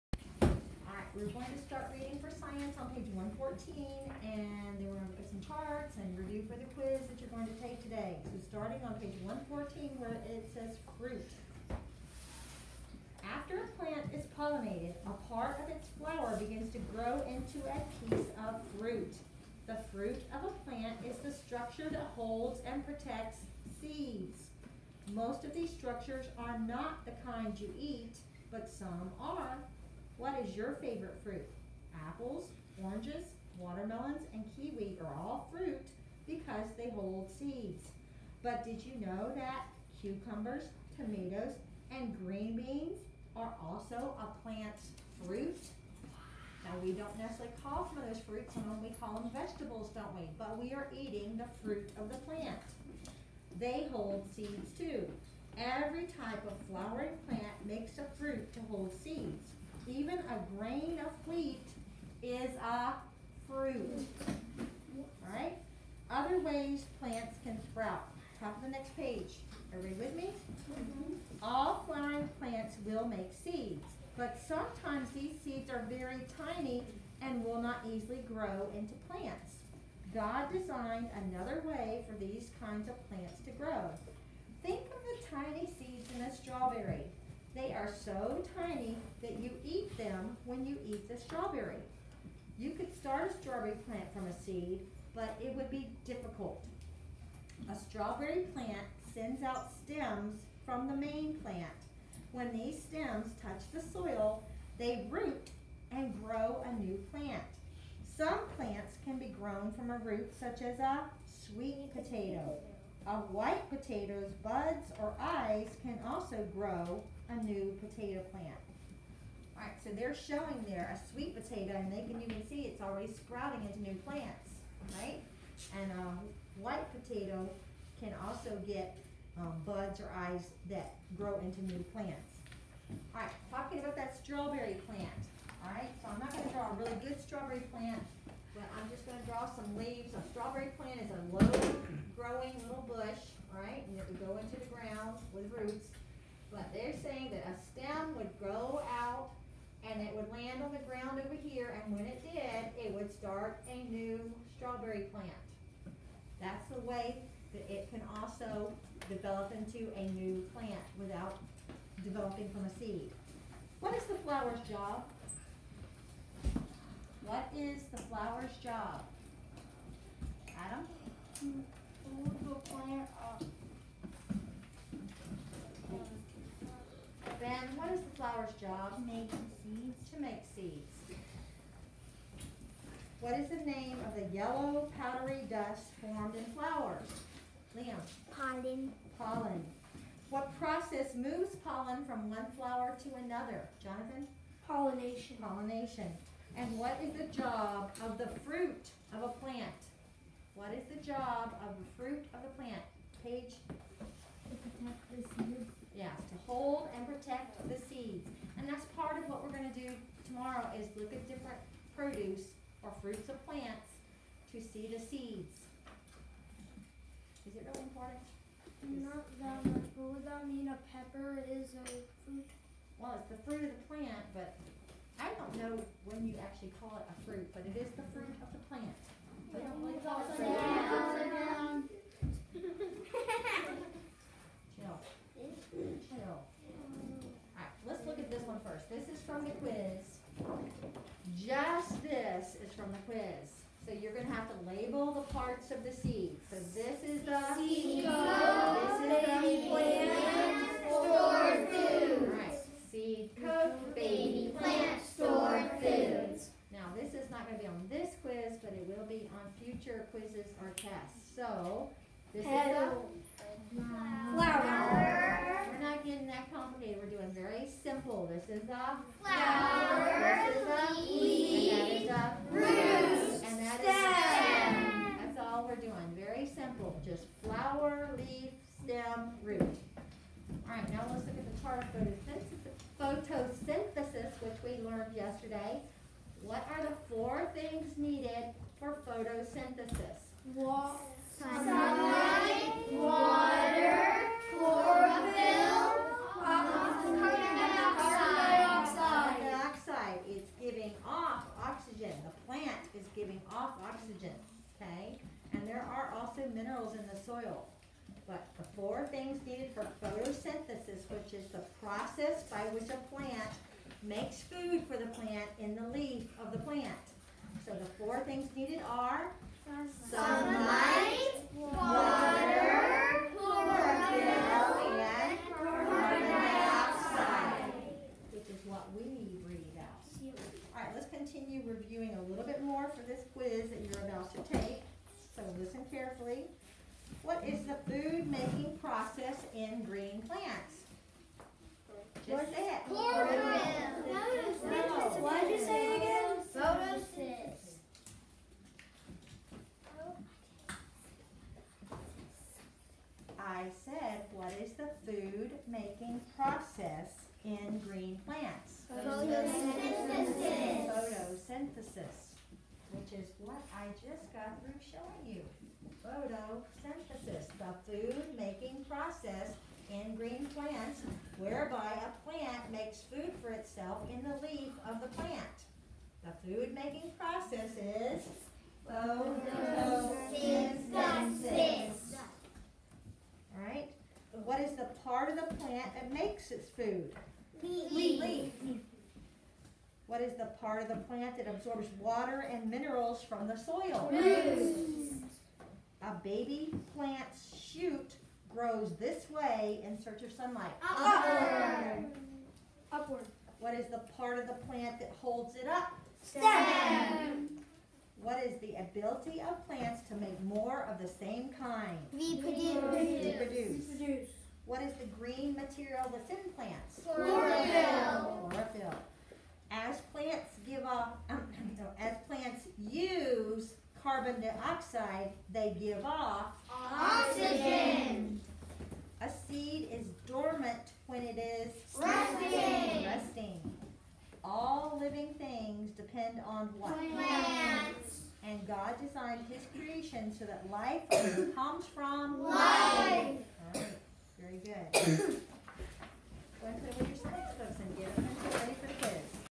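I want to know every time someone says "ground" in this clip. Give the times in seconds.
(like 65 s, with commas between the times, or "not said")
144 s, 150 s.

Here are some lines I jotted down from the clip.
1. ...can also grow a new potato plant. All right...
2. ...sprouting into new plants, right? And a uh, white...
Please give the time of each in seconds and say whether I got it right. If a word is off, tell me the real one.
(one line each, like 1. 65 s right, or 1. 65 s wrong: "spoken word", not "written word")
1. 115 s right
2. 123 s right.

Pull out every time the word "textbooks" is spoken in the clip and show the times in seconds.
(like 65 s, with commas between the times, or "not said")
447 s.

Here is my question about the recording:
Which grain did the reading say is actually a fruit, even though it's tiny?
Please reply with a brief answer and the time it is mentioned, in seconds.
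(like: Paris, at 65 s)
wheat, at 61 s.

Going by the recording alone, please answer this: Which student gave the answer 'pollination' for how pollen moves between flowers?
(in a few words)
Jonathan.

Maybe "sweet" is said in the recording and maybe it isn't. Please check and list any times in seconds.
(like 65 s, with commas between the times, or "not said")
111 s, 121 s.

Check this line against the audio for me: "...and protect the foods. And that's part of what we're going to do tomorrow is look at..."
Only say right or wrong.
wrong.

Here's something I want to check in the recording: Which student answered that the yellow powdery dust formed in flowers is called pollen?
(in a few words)
Liam.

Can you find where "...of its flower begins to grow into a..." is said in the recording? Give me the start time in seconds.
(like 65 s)
15 s.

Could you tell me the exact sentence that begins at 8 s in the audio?
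So starting on page 114 where it says fruit.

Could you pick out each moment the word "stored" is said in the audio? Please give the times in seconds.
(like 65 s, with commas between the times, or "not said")
250 s, 255 s.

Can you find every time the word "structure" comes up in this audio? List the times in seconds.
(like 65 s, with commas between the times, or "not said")
21 s, 25 s.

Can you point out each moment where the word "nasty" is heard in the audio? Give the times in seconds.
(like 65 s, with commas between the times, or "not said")
not said.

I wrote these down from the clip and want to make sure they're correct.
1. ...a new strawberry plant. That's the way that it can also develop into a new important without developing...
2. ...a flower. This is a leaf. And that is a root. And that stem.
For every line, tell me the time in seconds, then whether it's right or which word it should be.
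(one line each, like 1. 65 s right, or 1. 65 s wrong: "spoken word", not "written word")
1. 153 s wrong: "plant", not "important"
2. 268 s right.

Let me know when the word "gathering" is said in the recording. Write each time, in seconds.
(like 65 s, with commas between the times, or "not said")
not said.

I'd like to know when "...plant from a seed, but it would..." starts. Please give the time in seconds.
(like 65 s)
93 s.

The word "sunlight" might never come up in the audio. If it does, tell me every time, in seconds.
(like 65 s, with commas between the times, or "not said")
320 s, 400 s.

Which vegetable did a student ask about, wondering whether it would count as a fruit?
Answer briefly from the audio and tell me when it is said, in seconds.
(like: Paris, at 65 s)
pepper, at 220 s.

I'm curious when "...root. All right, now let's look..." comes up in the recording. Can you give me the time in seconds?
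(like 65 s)
279 s.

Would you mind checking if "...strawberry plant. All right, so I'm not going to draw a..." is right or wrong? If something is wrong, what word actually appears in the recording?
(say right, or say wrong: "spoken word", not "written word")
right.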